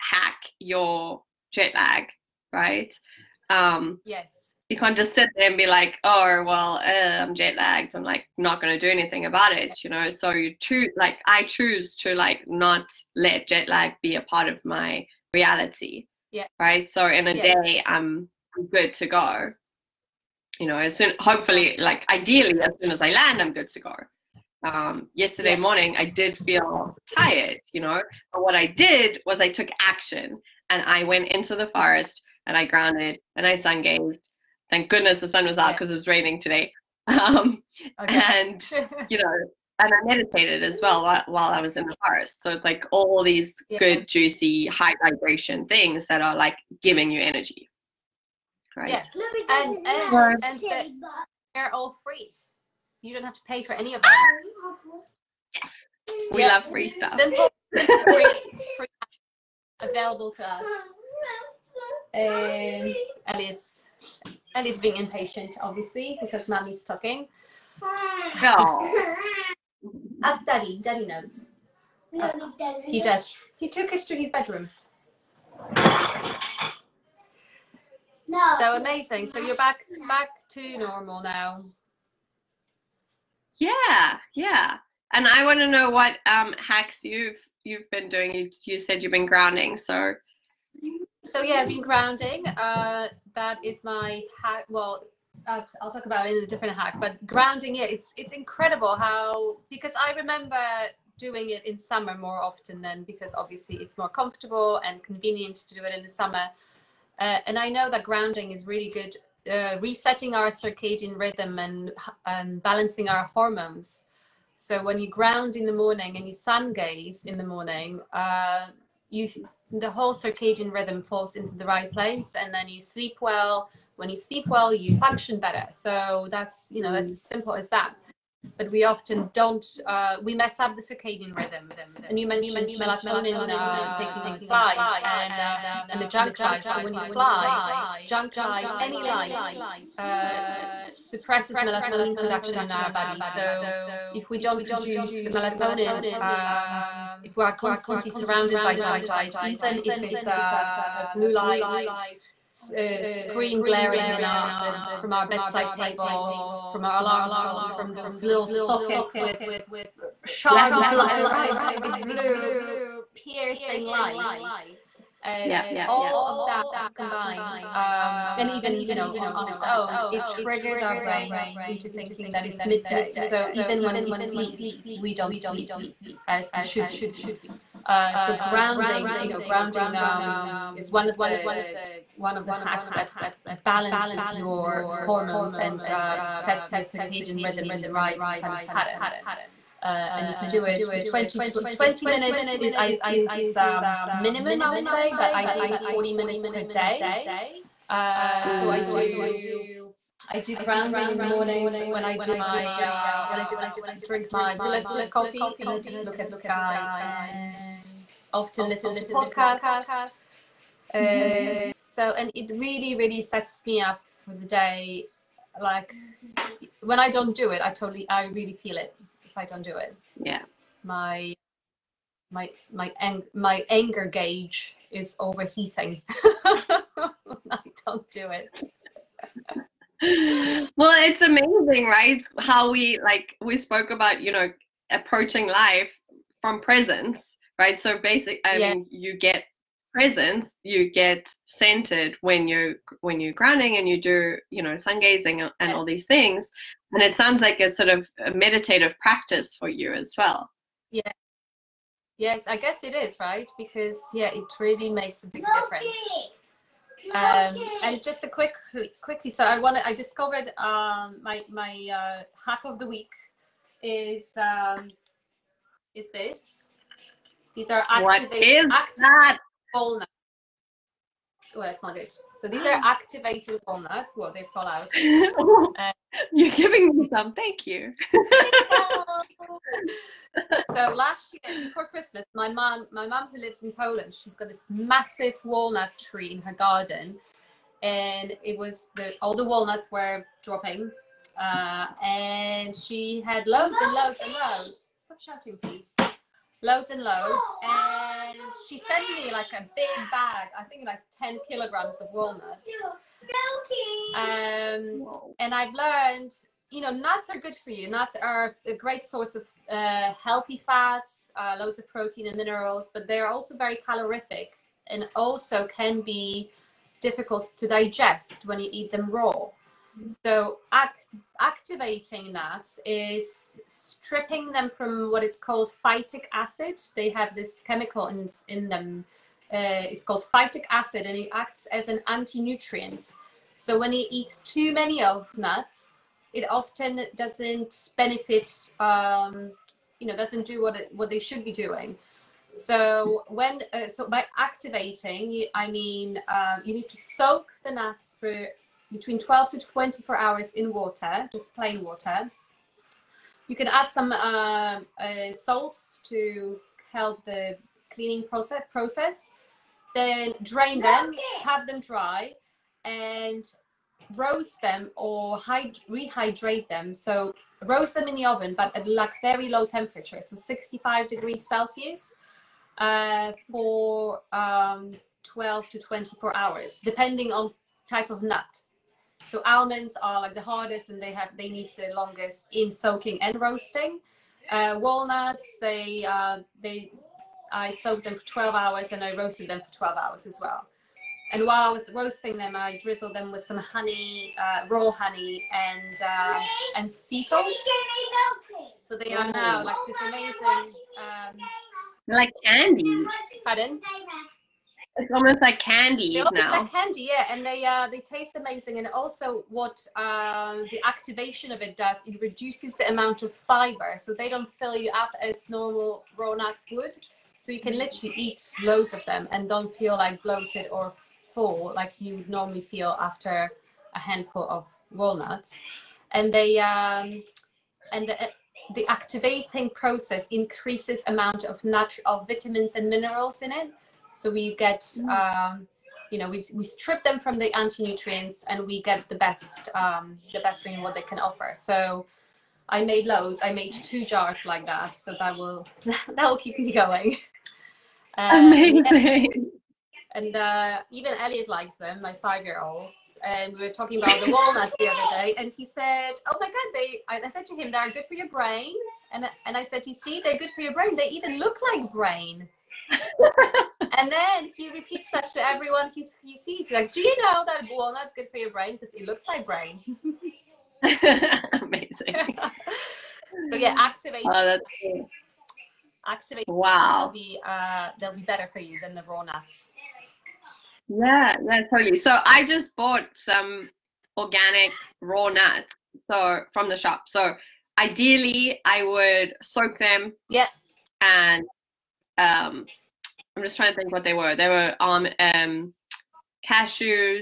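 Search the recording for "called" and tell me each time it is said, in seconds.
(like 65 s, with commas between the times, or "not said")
325 s, 330 s.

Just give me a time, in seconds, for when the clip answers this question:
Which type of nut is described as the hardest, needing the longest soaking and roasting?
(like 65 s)
379 s.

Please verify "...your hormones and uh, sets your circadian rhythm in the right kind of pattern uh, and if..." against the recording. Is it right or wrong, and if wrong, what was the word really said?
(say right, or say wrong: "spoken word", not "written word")
right.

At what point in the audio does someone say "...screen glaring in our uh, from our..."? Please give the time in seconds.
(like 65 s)
153 s.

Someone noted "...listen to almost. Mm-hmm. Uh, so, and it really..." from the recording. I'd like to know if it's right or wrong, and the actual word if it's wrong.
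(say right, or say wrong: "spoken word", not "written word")
wrong: "podcast", not "almost".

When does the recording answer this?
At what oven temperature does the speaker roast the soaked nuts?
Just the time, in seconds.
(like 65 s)
370 s.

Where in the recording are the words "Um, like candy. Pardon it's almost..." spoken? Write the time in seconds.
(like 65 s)
400 s.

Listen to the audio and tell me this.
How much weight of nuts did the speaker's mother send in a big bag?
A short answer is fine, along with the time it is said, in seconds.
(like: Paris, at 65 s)
10 kilograms, at 301 s.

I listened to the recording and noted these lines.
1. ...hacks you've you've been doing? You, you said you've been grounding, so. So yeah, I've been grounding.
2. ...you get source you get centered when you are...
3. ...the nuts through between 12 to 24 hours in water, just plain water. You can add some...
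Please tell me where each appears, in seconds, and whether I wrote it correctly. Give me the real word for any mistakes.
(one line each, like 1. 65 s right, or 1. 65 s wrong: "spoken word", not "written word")
1. 86 s right
2. 238 s wrong: "presence", not "source"
3. 347 s right.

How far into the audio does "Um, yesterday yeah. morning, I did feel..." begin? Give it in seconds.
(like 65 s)
24 s.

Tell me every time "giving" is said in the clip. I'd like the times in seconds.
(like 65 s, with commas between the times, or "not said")
46 s, 276 s.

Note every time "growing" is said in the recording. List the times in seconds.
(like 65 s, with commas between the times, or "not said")
not said.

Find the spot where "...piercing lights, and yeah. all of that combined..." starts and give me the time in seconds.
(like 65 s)
163 s.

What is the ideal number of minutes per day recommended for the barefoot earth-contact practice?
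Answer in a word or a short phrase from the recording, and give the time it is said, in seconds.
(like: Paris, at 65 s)
40 minutes, at 195 s.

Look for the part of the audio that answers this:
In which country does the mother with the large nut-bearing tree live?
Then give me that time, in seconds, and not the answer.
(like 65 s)
283 s.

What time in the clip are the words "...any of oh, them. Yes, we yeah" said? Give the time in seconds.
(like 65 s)
53 s.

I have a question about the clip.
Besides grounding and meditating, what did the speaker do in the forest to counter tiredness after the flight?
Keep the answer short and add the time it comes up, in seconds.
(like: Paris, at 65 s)
Sun gazed, at 33 s.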